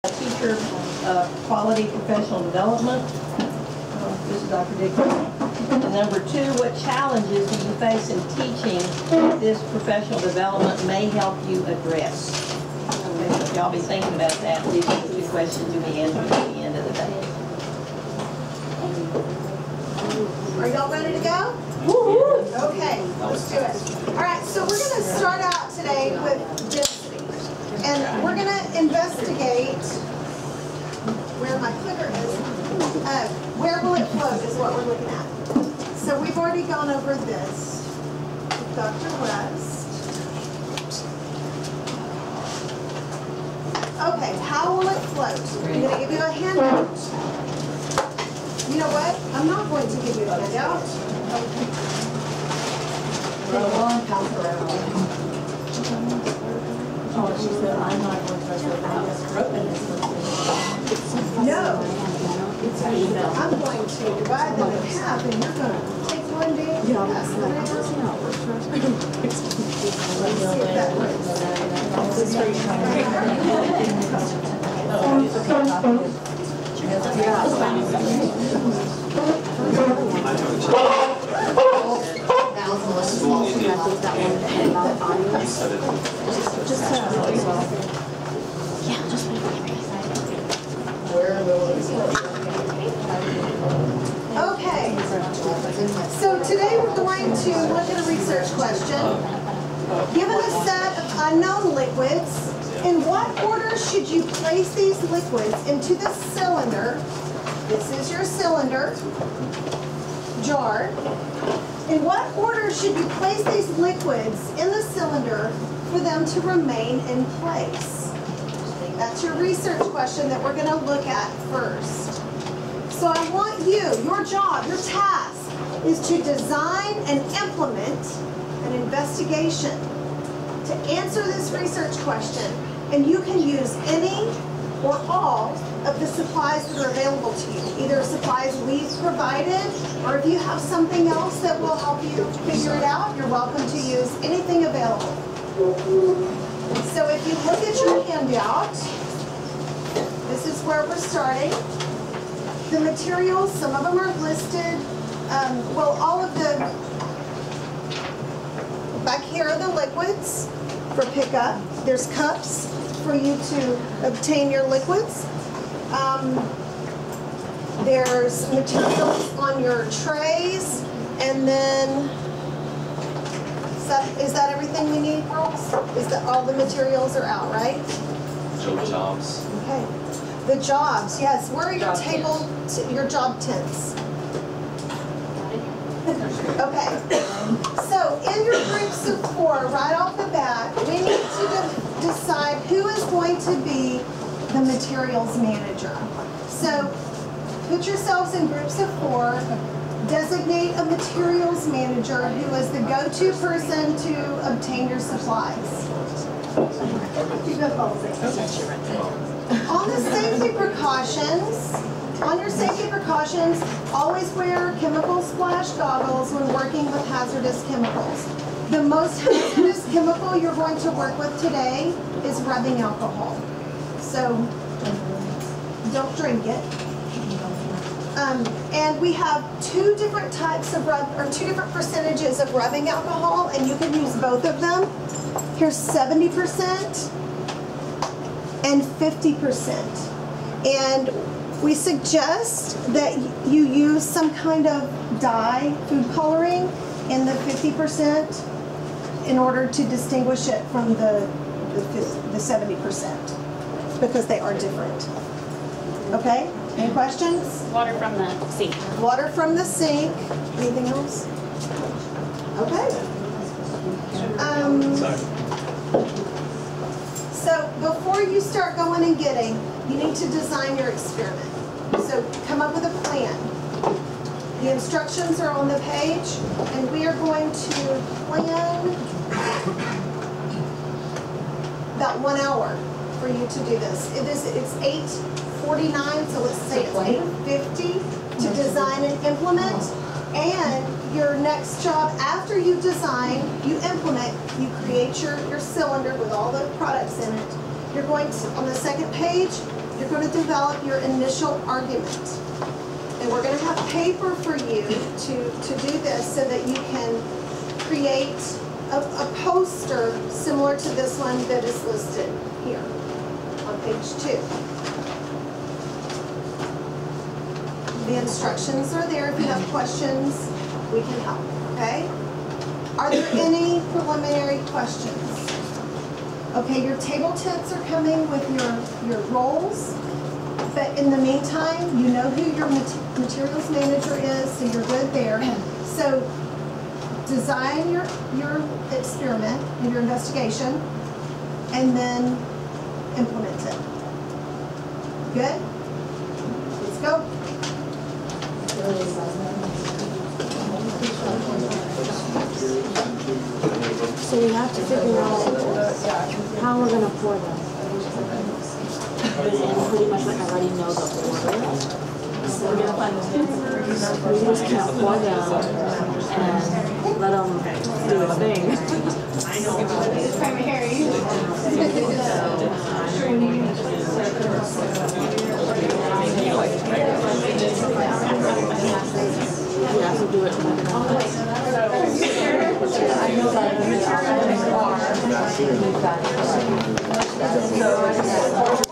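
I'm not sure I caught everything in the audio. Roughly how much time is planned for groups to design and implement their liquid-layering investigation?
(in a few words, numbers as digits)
One hour.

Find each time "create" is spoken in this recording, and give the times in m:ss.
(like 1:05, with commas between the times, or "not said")
4:54, 5:07.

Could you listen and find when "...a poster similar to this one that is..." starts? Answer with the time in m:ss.
5:08.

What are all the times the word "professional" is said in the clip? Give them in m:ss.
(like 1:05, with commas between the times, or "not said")
0:01, 0:09.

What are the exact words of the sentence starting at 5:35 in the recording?
So design your, your experiment and your investigation, and then implement it.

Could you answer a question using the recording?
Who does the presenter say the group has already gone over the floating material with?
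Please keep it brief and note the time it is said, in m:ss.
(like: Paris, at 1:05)
Dr. West, at 0:38.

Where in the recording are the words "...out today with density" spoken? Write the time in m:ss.
0:25.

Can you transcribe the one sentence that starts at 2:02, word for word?
So I want you, your job, your task, is to design and implement an investigation to answer this research question.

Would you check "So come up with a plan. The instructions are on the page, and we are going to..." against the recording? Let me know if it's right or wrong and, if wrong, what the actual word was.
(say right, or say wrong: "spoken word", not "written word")
right.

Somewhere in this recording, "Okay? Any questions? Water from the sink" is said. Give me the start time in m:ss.
4:16.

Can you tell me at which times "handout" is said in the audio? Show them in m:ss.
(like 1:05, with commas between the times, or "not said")
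0:46, 0:50, 2:28.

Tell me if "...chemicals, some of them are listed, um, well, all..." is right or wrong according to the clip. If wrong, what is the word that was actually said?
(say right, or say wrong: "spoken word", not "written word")
wrong: "materials", not "chemicals".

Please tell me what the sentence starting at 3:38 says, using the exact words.
The most hazardous chemical you're going to work with today is rubbing alcohol.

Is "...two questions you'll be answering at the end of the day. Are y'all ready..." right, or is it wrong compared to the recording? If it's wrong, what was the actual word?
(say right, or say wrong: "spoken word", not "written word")
right.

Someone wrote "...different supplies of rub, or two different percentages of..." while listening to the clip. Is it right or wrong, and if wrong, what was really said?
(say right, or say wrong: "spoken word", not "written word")
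wrong: "types", not "supplies".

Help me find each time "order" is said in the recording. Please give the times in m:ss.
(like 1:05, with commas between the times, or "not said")
1:43, 1:52, 4:09, 6:01.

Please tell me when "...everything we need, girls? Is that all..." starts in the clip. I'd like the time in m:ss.
2:54.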